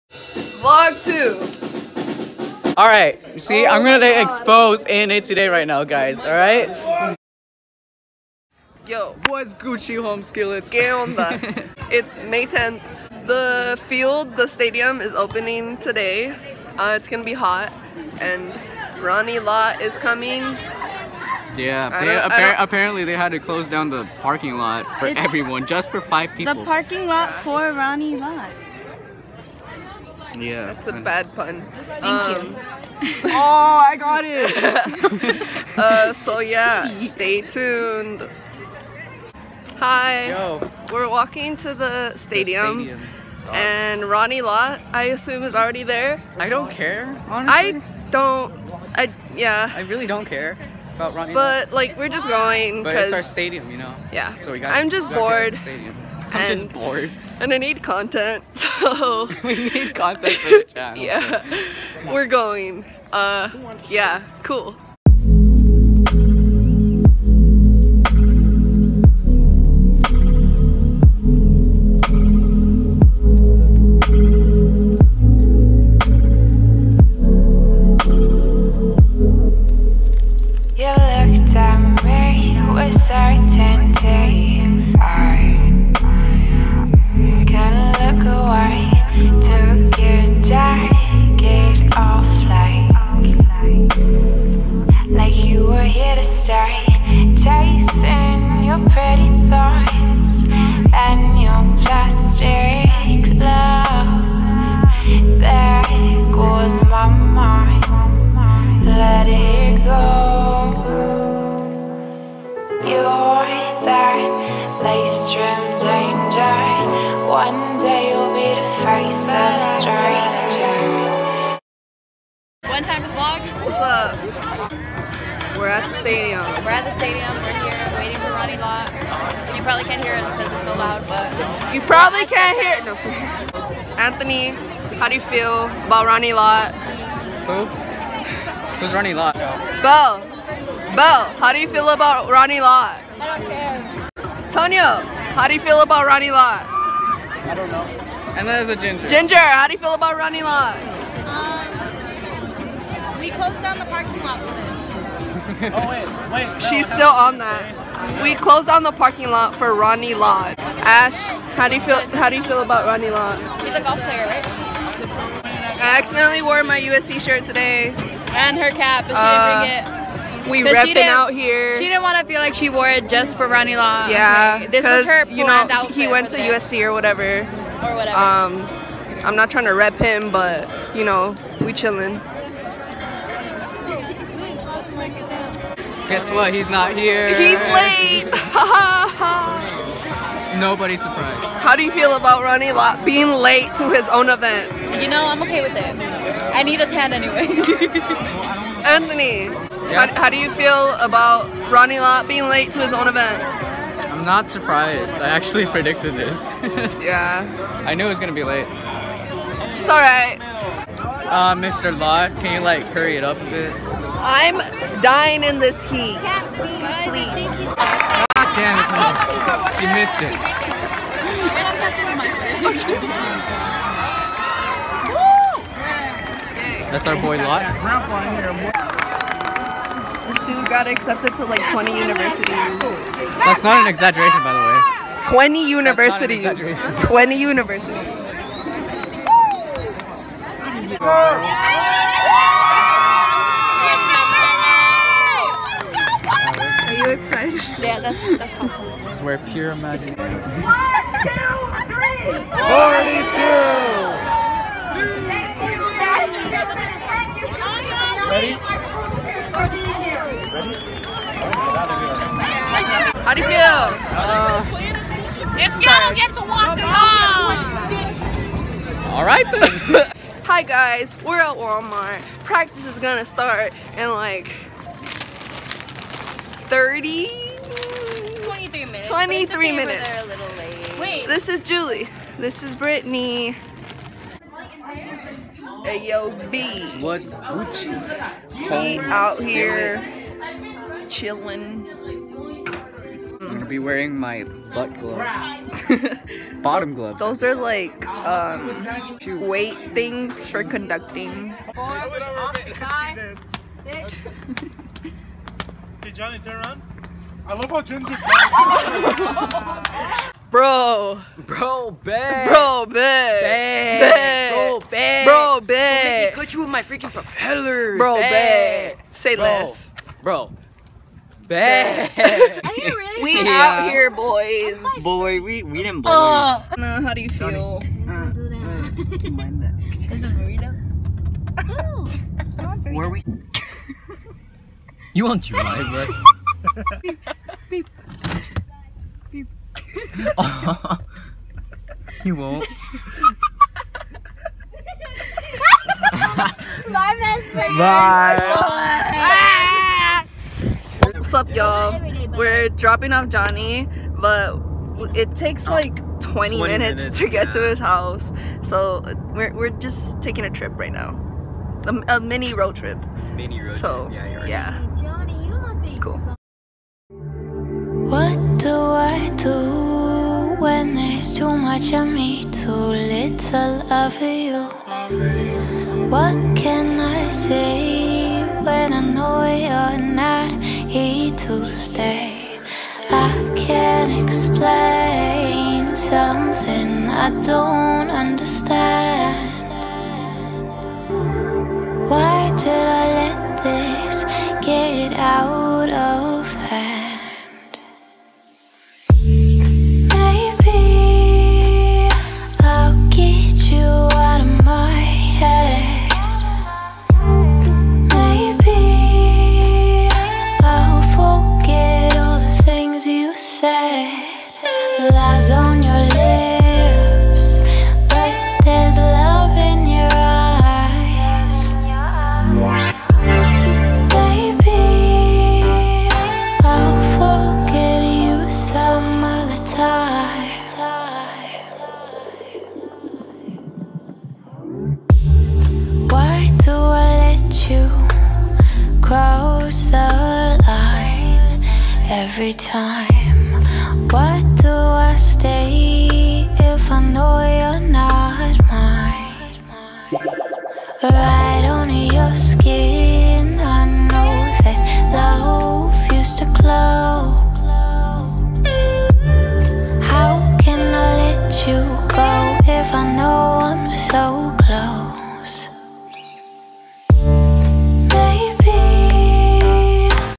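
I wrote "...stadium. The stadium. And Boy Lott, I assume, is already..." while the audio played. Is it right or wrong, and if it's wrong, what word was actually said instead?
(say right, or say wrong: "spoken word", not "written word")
wrong: "Ronnie", not "Boy".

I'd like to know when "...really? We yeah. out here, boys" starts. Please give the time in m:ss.
5:22.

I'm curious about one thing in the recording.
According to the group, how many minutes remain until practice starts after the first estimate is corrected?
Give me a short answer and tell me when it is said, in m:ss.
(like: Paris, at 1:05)
23, at 4:38.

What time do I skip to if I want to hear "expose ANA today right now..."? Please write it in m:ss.
0:04.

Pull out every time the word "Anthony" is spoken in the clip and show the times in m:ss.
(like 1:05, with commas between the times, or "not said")
2:13, 3:18.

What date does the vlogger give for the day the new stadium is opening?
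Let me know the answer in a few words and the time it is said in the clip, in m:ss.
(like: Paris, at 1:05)
May 10th, at 0:12.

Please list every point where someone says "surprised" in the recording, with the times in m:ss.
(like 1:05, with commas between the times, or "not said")
3:11, 3:24.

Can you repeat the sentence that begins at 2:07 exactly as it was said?
We're here waiting for Ronnie Lott.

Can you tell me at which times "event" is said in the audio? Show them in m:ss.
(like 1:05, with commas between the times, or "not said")
3:14, 3:23.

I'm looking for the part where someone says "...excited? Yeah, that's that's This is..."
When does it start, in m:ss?
4:07.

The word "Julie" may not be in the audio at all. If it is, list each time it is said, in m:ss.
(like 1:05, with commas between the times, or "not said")
4:41.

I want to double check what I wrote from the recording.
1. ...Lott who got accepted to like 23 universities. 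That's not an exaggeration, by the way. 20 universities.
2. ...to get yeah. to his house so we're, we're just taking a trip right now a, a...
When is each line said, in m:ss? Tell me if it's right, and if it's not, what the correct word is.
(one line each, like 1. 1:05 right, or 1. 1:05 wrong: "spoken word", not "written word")
1. 3:47 wrong: "20", not "23"
2. 5:57 right.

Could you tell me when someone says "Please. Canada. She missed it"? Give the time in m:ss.
3:37.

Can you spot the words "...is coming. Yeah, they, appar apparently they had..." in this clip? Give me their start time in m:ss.
0:19.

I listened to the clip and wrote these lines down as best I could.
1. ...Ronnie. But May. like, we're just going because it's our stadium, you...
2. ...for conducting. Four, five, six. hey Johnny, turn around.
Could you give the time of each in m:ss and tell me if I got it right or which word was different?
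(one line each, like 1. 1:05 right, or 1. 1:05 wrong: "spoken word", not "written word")
1. 0:51 wrong: "Lott", not "May"
2. 5:00 right.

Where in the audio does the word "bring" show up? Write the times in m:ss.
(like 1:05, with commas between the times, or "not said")
2:49.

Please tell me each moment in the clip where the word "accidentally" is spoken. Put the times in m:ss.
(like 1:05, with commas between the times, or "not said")
2:45.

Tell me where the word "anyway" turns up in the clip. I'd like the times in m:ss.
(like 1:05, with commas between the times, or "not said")
3:17.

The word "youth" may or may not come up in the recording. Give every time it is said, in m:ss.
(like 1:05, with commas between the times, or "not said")
not said.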